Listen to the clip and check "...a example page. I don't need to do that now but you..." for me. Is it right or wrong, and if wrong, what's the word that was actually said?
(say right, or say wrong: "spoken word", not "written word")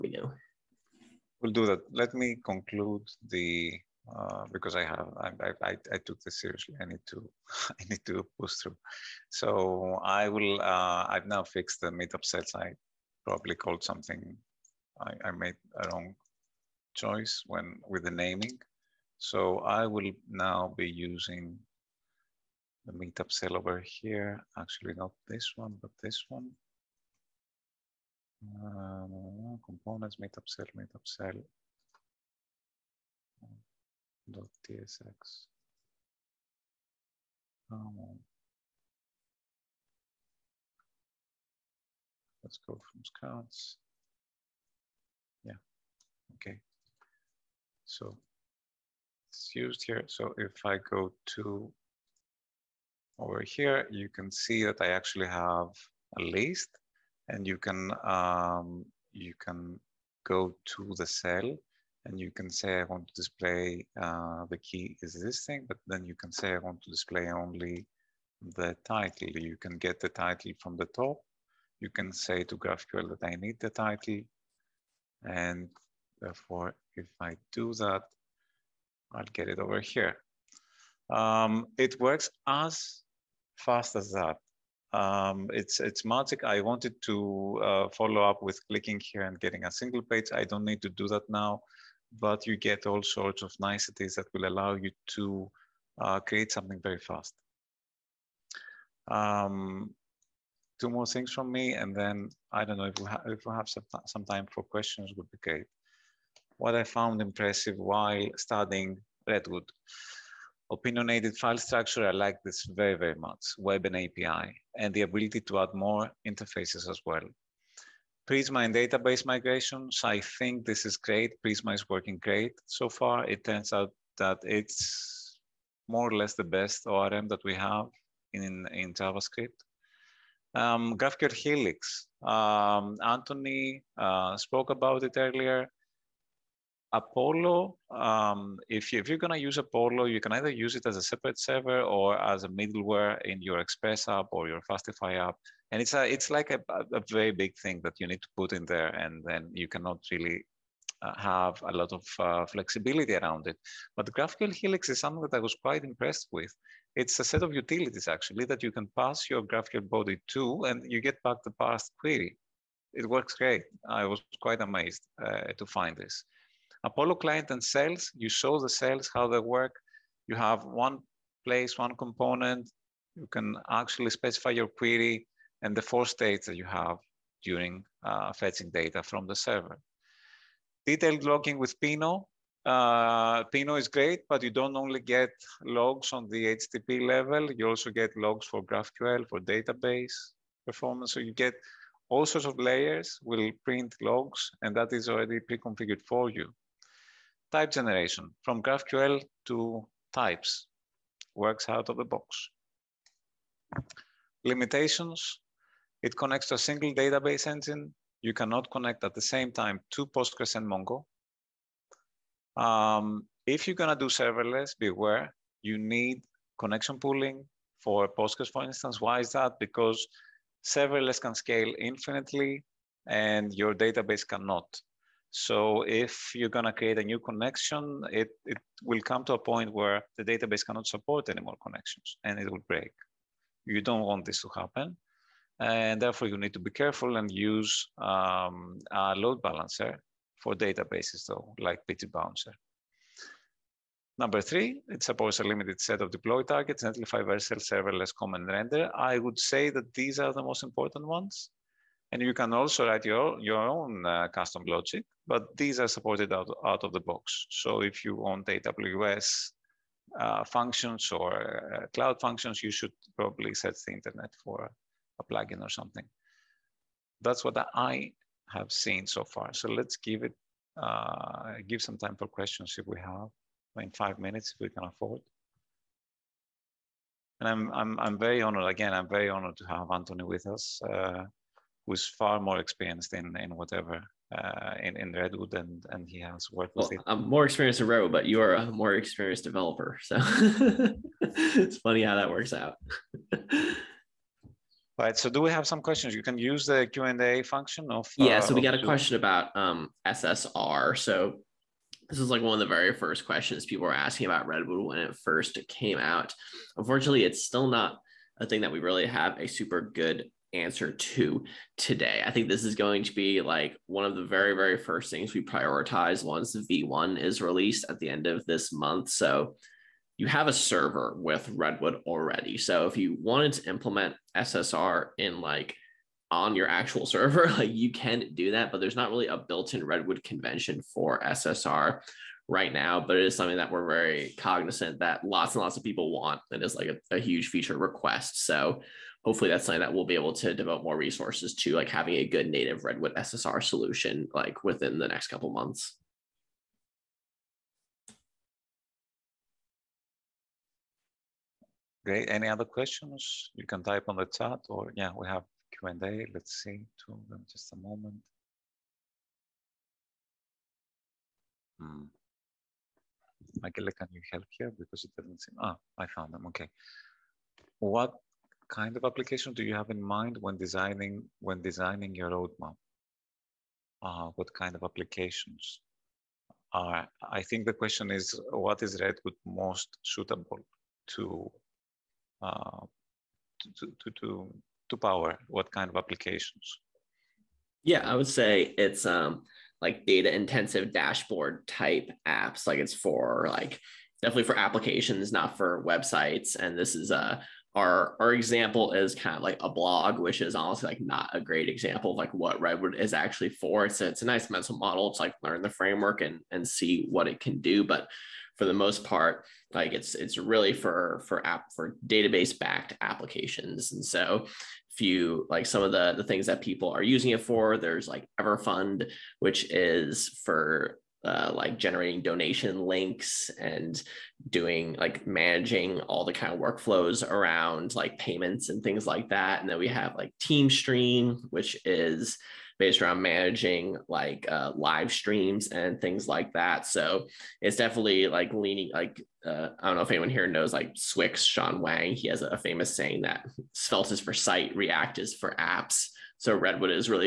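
wrong: "single", not "example".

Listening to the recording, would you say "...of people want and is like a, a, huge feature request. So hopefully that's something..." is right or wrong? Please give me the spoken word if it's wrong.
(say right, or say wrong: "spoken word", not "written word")
right.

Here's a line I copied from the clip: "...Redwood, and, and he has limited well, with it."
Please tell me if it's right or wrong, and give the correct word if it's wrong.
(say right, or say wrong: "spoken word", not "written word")
wrong: "worked", not "limited".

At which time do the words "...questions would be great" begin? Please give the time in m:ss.
1:44.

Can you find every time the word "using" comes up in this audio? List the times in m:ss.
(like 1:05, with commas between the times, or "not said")
0:20, 6:57.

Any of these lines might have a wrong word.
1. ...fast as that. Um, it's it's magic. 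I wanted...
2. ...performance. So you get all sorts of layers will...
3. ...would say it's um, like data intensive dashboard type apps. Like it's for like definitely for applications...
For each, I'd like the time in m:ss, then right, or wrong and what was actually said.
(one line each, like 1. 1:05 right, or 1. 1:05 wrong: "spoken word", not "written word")
1. 1:23 right
2. 3:10 right
3. 6:28 right.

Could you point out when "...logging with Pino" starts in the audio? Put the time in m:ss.
3:01.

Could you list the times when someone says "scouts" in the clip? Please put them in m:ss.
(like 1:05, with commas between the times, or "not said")
0:43.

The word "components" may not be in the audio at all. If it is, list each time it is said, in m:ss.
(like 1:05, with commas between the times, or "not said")
0:29, 2:51.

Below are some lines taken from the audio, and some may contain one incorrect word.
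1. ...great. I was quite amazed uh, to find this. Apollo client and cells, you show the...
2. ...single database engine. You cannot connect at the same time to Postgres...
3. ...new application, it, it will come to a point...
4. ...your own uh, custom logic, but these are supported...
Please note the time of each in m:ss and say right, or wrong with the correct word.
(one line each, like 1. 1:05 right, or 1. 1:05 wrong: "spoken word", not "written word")
1. 2:43 right
2. 3:26 right
3. 3:47 wrong: "connection", not "application"
4. 4:13 right.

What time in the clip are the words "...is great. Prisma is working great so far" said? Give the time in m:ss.
2:00.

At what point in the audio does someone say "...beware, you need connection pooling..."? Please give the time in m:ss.
3:34.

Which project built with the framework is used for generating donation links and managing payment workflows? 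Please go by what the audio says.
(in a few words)
everfund.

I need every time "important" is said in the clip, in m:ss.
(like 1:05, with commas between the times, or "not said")
4:10.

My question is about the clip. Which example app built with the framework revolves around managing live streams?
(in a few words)
teamstream.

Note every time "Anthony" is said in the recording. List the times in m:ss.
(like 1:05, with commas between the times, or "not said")
2:13, 4:39.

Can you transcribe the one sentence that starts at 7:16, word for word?
So it's definitely like leaning like uh, I don't know if anyone here knows like Swyx Shawn Wang.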